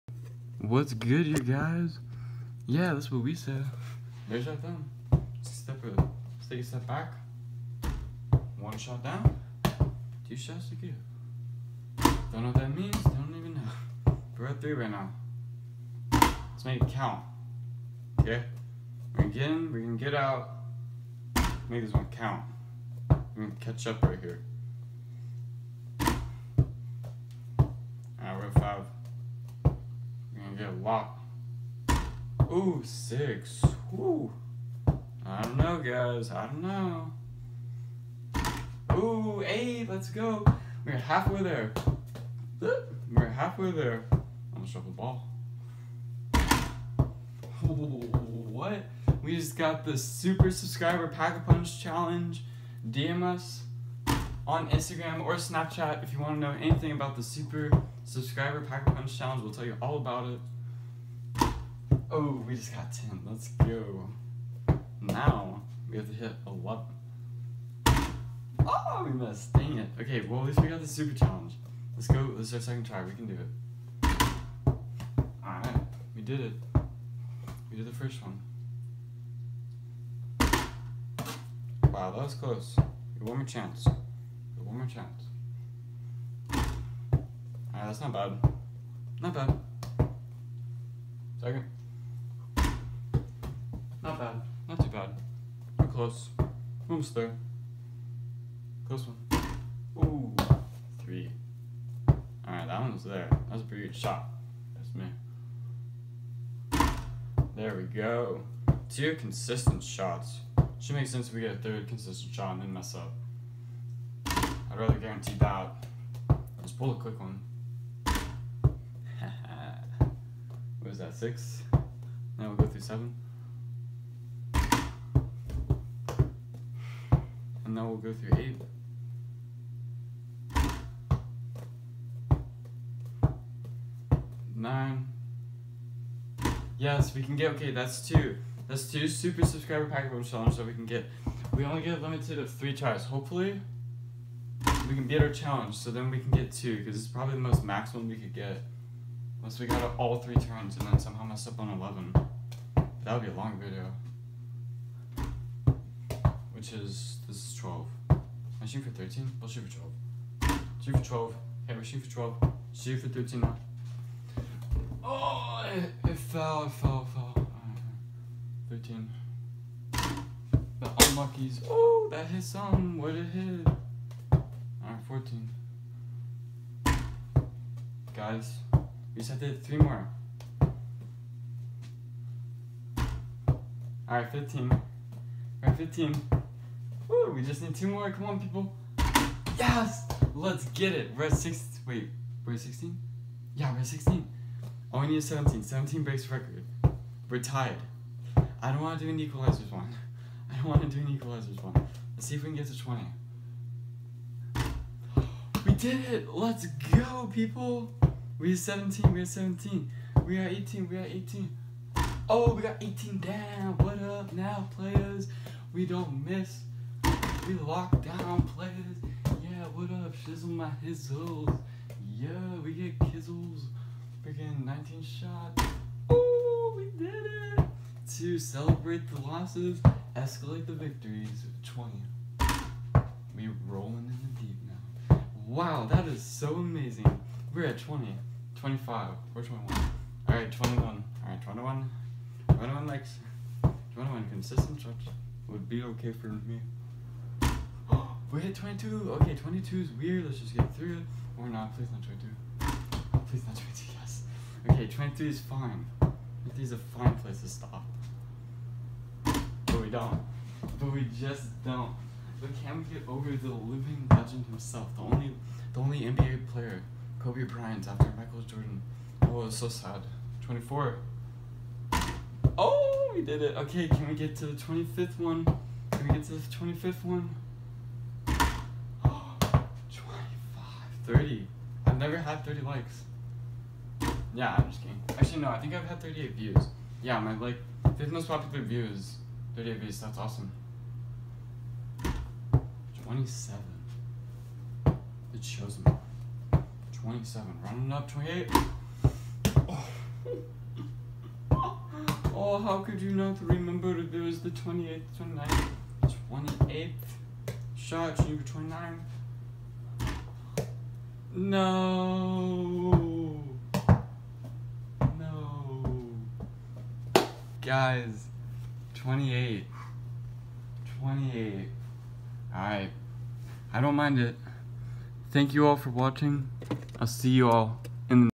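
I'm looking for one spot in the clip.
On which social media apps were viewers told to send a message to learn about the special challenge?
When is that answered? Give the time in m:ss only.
0:54.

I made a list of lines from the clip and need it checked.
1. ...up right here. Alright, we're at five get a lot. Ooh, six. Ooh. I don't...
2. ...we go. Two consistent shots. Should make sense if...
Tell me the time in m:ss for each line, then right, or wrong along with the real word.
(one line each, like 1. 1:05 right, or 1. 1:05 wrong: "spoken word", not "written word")
1. 0:23 right
2. 1:47 right.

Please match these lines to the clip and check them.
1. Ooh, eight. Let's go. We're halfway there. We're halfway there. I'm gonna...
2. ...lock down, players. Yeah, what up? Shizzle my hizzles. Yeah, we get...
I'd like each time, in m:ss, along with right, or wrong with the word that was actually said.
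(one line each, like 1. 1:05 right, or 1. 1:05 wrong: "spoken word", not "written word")
1. 0:38 right
2. 3:37 right.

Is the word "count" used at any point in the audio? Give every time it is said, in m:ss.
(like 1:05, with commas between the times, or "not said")
0:16, 0:22.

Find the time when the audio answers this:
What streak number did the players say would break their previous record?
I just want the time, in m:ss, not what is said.
3:15.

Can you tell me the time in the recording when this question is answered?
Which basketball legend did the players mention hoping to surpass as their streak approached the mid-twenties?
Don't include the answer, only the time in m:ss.
4:27.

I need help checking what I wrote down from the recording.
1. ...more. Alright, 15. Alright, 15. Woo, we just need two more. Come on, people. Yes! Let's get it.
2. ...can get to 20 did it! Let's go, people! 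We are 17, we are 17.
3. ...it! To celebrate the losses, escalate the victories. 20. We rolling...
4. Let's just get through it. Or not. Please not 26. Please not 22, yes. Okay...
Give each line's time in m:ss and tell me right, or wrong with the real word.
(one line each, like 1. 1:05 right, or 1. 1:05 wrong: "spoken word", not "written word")
1. 2:59 right
2. 3:22 right
3. 3:47 right
4. 4:10 wrong: "22", not "26".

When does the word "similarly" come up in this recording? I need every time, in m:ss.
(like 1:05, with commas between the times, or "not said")
not said.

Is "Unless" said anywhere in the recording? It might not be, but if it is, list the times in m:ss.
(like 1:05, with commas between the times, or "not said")
2:29.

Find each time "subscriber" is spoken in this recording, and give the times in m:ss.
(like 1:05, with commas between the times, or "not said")
0:50, 0:58, 2:19.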